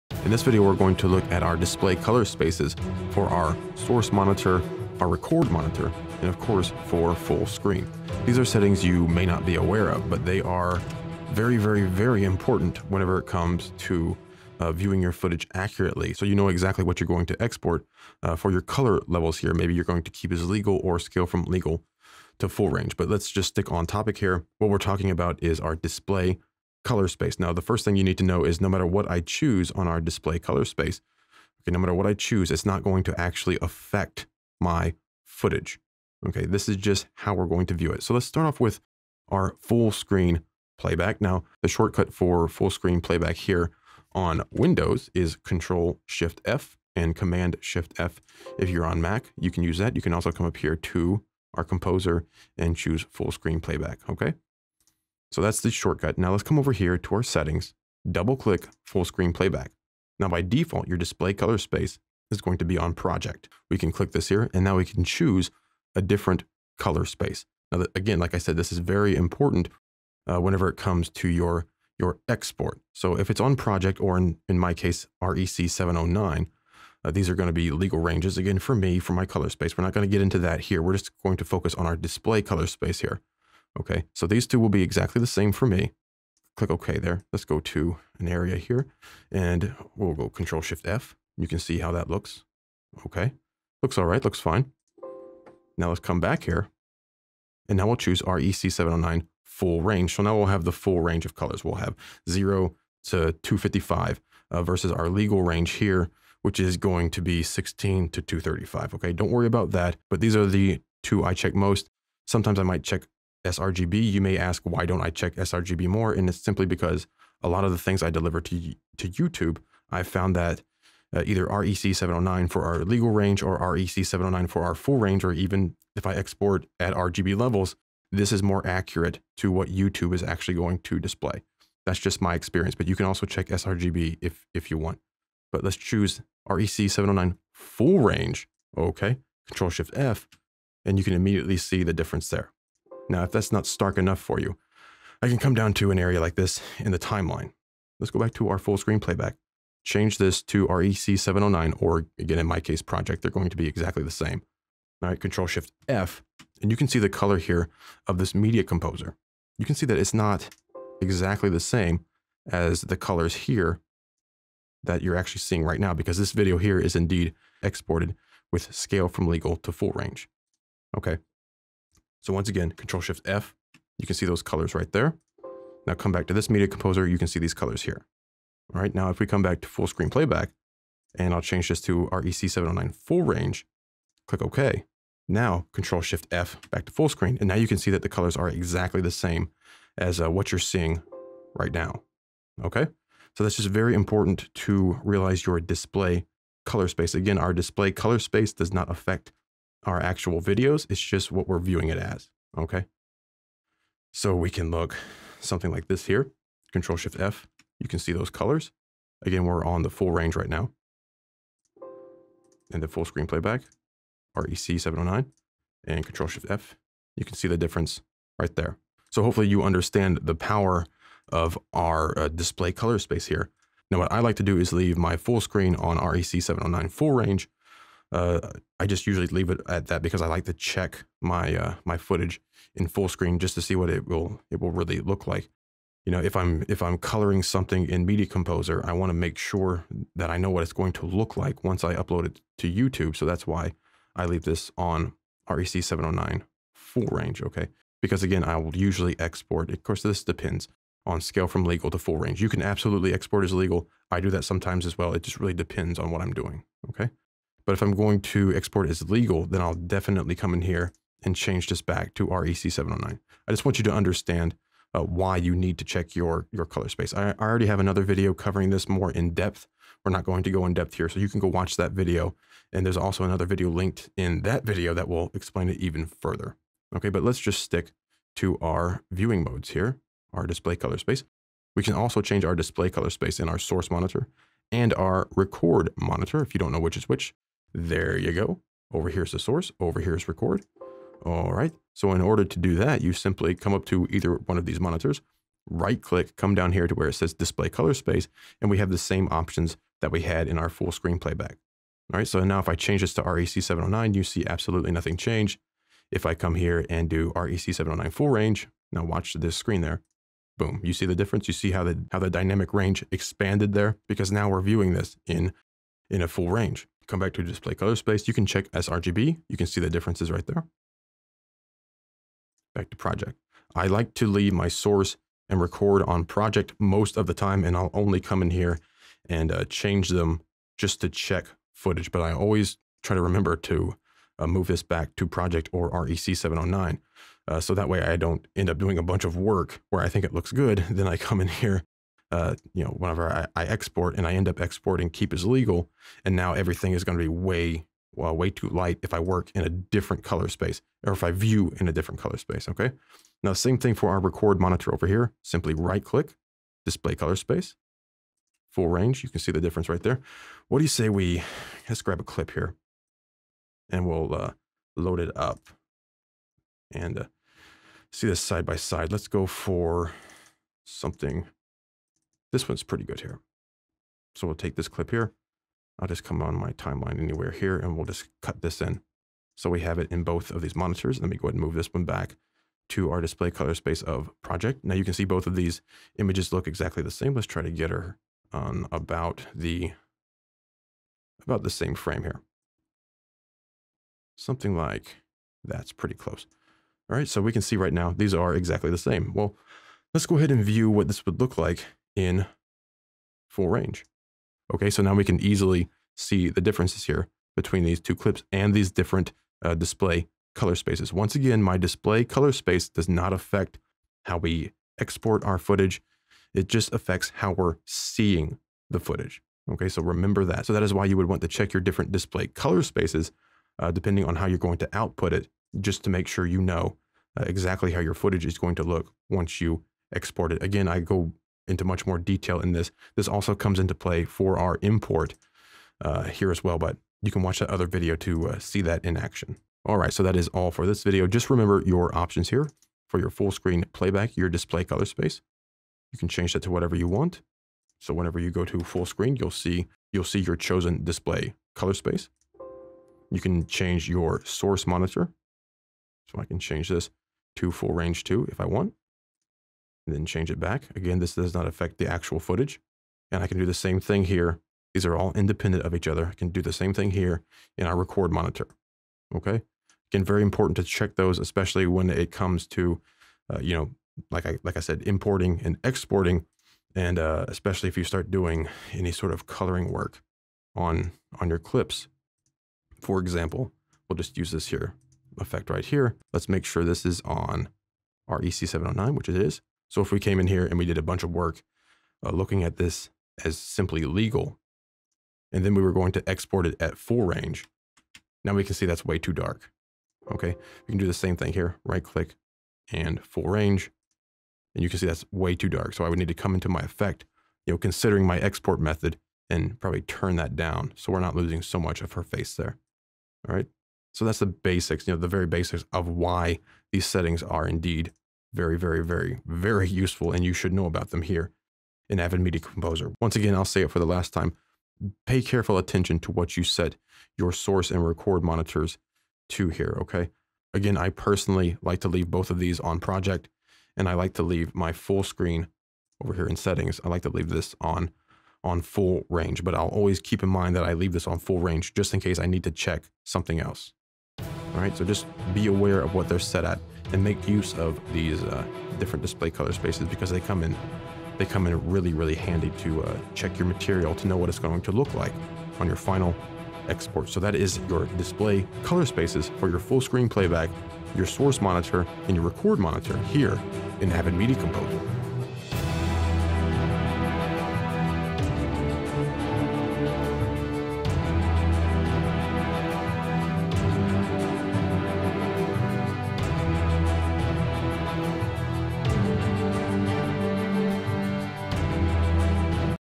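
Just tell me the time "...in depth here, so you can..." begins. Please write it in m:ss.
4:30.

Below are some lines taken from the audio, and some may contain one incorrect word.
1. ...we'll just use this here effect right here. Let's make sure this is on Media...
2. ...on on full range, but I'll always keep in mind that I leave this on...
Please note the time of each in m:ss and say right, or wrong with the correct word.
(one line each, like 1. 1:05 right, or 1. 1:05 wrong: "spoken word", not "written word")
1. 8:04 wrong: "REC", not "Media"
2. 8:57 right.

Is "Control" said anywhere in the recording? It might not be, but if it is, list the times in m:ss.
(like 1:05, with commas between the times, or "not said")
0:45, 1:30, 2:19, 2:35, 2:52, 3:05, 3:26, 3:36.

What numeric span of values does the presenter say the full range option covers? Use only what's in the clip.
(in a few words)
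0 to 255.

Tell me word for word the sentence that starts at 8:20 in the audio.
Okay, we can do the same thing here, right click and full range.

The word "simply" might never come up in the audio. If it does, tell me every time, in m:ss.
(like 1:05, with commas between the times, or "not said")
1:56, 4:53, 5:55, 8:13.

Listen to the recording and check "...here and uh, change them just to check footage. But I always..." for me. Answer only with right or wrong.
right.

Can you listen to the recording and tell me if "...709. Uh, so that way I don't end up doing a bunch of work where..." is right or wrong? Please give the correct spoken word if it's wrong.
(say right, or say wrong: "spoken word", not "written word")
right.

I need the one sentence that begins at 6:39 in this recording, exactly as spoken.
Well, let's go ahead and view what this would look like in full range.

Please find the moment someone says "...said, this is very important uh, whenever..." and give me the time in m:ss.
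1:08.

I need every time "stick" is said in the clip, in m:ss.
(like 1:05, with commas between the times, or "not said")
0:23, 4:37.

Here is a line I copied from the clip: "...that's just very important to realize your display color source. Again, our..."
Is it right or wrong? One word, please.
wrong.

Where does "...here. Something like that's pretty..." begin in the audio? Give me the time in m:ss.
6:32.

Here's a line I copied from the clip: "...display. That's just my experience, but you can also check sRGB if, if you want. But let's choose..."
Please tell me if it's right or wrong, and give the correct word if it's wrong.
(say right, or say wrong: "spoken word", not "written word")
right.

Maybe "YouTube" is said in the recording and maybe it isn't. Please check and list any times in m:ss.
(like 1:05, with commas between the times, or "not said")
1:59, 2:09, 4:02.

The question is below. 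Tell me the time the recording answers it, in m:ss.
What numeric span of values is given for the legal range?
1:47.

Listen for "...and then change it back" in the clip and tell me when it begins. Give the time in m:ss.
7:40.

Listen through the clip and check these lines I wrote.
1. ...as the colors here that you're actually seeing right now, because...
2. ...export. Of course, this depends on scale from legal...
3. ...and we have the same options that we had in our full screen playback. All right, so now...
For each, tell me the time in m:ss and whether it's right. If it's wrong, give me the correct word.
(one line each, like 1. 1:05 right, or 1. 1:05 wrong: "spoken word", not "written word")
1. 2:42 right
2. 4:09 right
3. 4:58 right.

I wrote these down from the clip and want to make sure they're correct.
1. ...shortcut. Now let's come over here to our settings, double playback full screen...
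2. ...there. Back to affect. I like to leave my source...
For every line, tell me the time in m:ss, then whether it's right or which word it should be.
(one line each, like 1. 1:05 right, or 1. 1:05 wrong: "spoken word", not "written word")
1. 0:55 wrong: "click", not "playback"
2. 5:20 wrong: "project", not "affect".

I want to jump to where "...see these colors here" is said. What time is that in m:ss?
2:57.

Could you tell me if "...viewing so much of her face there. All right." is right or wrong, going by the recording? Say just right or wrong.
wrong.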